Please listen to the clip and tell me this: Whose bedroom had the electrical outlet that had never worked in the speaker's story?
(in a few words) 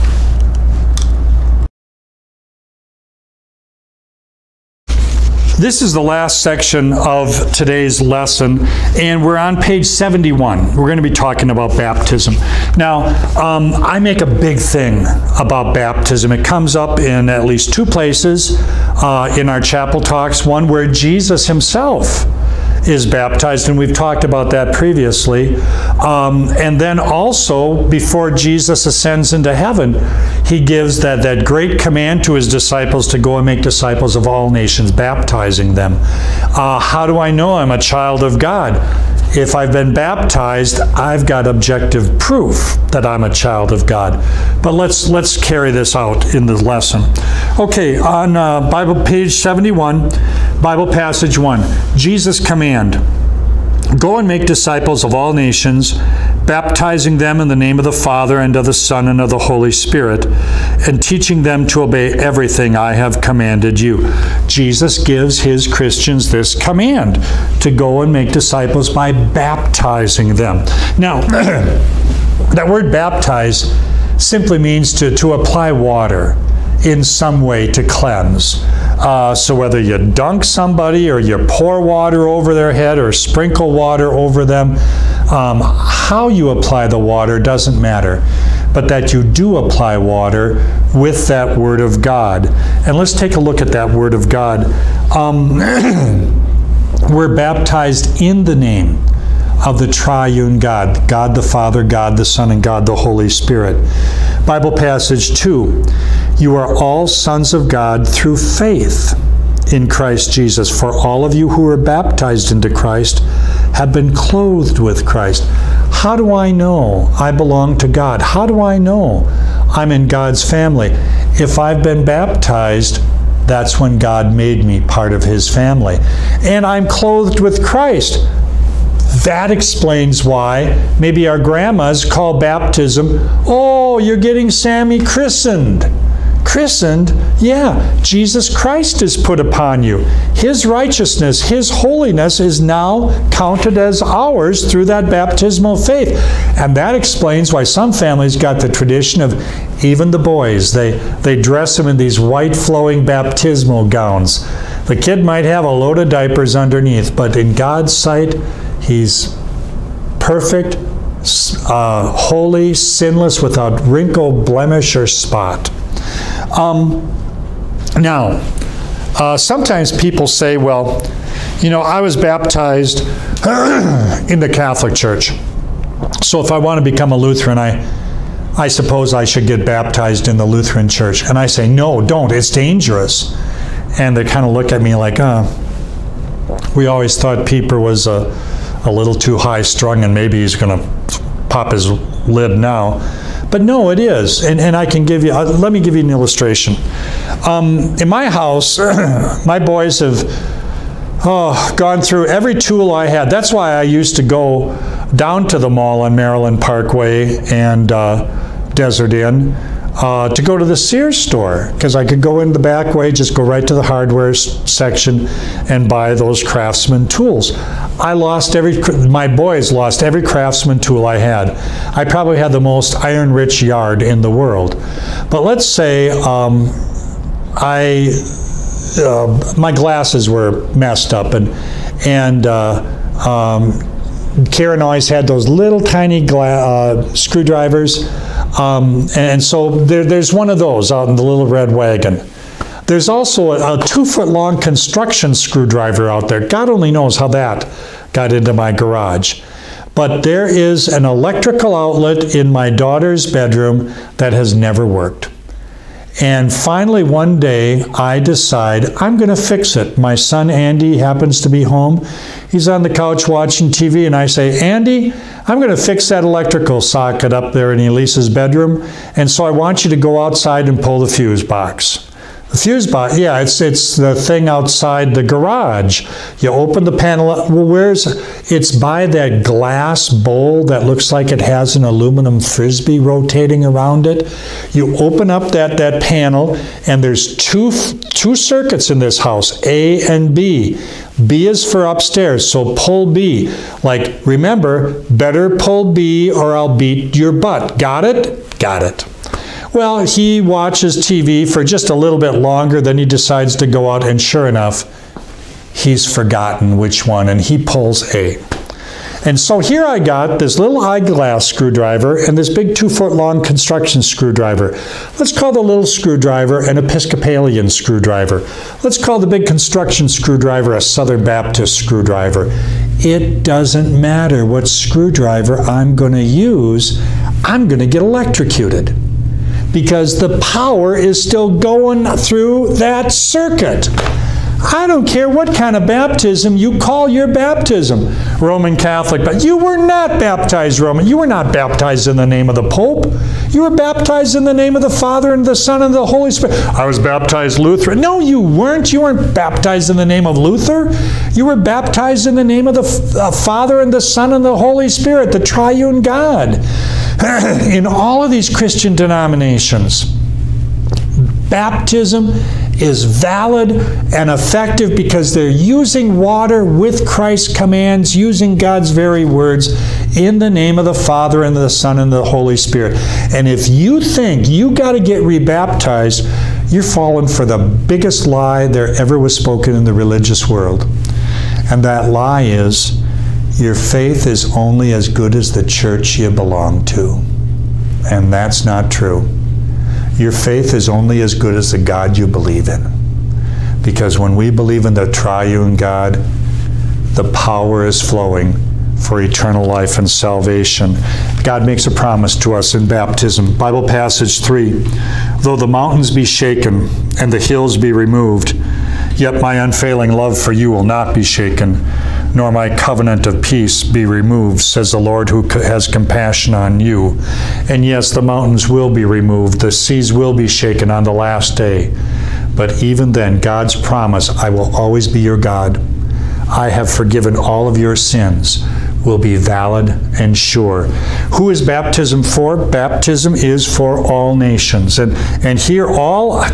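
Elisa.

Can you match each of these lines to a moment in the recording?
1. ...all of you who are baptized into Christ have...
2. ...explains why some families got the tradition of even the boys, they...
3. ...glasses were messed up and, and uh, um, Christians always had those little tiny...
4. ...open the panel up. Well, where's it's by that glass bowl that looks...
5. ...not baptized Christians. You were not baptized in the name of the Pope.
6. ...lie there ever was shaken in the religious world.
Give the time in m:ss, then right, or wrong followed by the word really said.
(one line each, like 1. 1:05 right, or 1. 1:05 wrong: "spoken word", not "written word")
1. 1:50 right
2. 2:26 right
3. 3:49 wrong: "Karen", not "Christians"
4. 4:36 right
5. 5:39 wrong: "Roman", not "Christians"
6. 6:18 wrong: "spoken", not "shaken".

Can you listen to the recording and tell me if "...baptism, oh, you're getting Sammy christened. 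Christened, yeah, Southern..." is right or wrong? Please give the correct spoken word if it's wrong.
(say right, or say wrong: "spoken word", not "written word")
wrong: "Jesus", not "Southern".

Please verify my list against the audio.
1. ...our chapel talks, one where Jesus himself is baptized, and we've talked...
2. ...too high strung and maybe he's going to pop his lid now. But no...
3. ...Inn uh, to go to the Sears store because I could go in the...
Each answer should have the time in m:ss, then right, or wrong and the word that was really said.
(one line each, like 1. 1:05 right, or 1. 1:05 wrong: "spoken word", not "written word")
1. 0:19 right
2. 3:09 right
3. 3:29 right.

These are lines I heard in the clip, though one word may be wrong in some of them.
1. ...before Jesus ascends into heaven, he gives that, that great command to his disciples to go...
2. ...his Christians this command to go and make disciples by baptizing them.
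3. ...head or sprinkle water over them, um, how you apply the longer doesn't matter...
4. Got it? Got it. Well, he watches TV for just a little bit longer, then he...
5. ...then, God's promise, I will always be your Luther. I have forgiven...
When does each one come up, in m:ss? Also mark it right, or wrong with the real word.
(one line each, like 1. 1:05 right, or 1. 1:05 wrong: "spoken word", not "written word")
1. 0:27 right
2. 1:05 right
3. 1:22 wrong: "water", not "longer"
4. 4:57 right
5. 7:03 wrong: "God", not "Luther".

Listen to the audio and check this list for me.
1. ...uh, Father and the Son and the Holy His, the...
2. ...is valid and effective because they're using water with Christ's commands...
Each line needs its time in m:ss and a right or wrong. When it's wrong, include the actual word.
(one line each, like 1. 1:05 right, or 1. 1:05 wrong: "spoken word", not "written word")
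1. 5:53 wrong: "Spirit", not "His"
2. 6:02 right.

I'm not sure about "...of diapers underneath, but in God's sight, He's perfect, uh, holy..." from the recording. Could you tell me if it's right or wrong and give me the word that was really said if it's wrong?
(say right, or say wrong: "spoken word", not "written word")
right.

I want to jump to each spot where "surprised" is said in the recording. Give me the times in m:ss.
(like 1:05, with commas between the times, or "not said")
not said.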